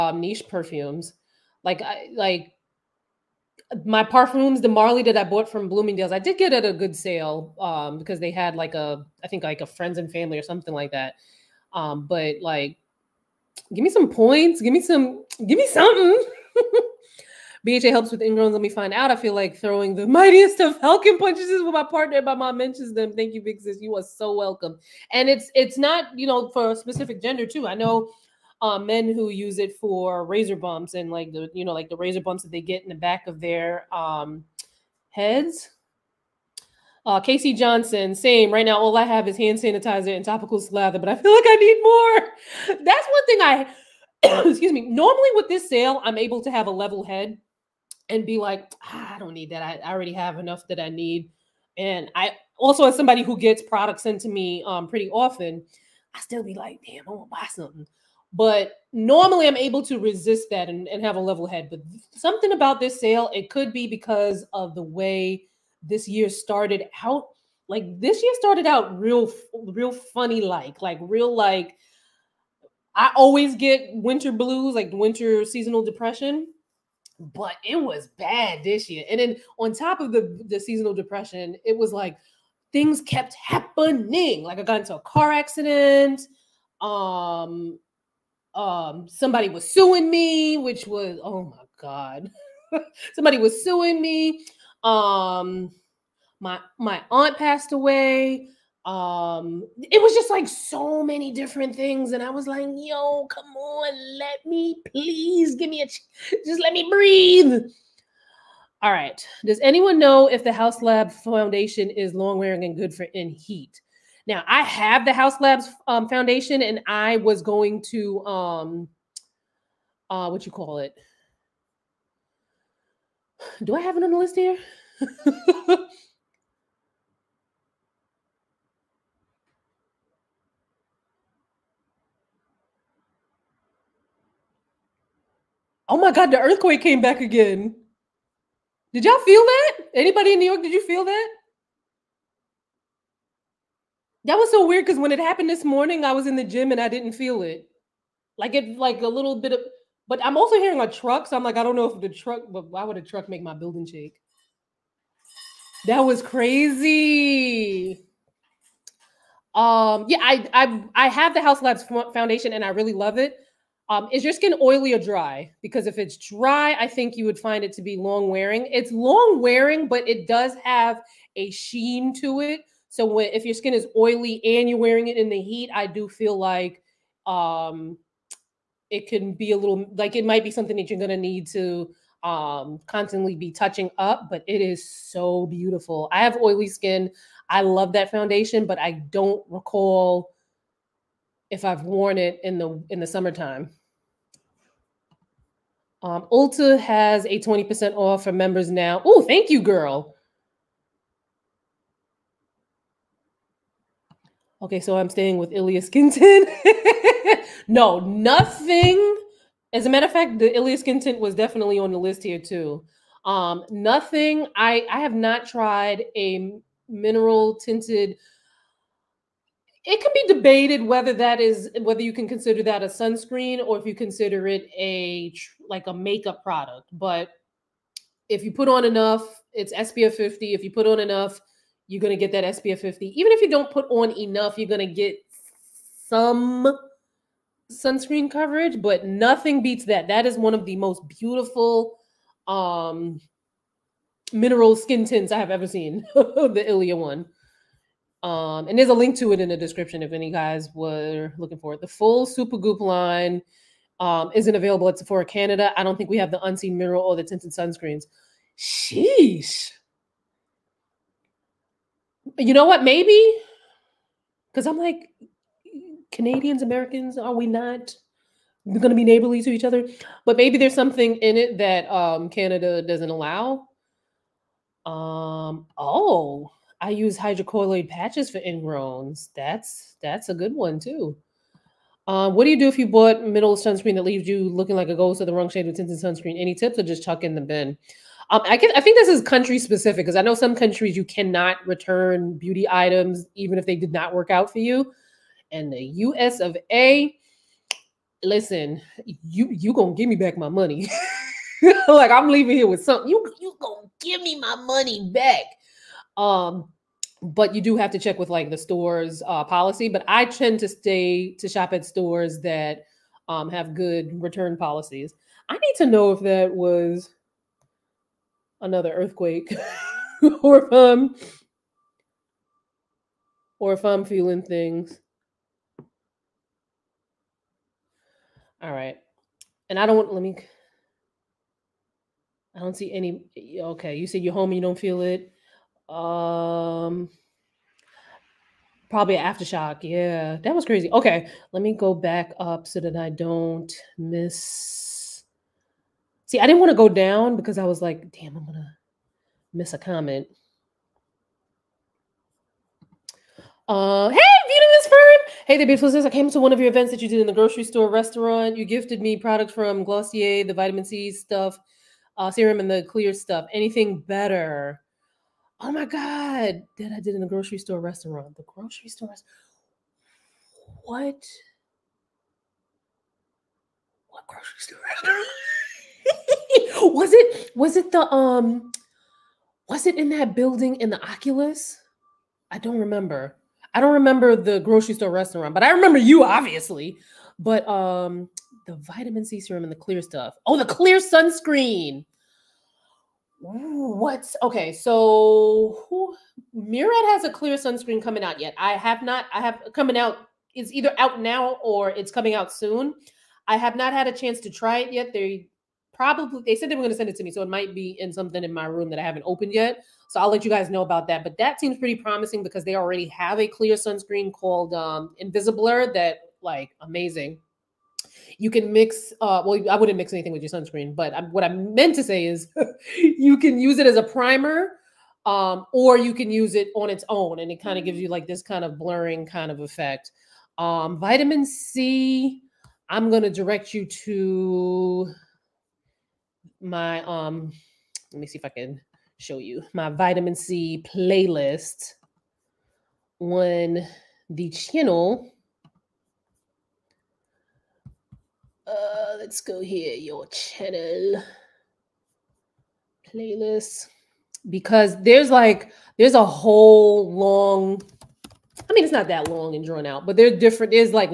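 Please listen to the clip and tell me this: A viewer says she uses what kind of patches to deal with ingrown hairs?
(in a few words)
hydrocolloid patches.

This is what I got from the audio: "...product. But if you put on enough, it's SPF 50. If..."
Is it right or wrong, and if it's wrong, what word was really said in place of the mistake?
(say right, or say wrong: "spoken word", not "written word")
right.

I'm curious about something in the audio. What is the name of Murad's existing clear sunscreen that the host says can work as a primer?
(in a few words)
Invisiblur.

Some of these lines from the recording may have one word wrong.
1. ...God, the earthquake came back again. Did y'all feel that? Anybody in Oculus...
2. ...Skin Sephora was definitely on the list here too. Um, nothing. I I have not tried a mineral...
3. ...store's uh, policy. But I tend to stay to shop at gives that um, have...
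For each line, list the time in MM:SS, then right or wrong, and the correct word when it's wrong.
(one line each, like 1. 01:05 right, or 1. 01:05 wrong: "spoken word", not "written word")
1. 02:16 wrong: "New", not "Oculus"
2. 03:30 wrong: "Tint", not "Sephora"
3. 05:08 wrong: "stores", not "gives".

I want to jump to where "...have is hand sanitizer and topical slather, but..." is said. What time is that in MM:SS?
00:39.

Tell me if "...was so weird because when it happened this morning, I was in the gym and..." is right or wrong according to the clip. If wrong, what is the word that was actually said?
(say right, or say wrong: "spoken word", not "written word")
right.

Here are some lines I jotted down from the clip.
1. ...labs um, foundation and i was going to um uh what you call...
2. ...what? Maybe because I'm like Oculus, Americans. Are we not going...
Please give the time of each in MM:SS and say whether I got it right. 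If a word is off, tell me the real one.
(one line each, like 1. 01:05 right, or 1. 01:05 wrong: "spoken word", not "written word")
1. 01:55 right
2. 04:22 wrong: "Canadians", not "Oculus".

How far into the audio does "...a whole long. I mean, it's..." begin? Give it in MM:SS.
07:36.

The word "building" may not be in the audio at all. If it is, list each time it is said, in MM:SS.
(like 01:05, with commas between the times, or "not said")
02:33, 06:20.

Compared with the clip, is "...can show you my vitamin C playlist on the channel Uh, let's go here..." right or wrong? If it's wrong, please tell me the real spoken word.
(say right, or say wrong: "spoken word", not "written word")
right.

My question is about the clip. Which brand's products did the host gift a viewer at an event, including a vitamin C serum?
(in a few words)
Glossier.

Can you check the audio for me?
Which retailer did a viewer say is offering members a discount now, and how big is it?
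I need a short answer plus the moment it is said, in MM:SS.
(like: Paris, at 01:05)
Ulta, 20% off, at 03:16.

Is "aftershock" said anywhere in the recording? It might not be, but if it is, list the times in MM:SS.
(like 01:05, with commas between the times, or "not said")
05:39.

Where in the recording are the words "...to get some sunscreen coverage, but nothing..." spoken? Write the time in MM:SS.
03:54.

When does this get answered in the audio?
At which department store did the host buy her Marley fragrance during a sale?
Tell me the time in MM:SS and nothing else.
00:05.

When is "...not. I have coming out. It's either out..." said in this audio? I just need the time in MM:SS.
06:39.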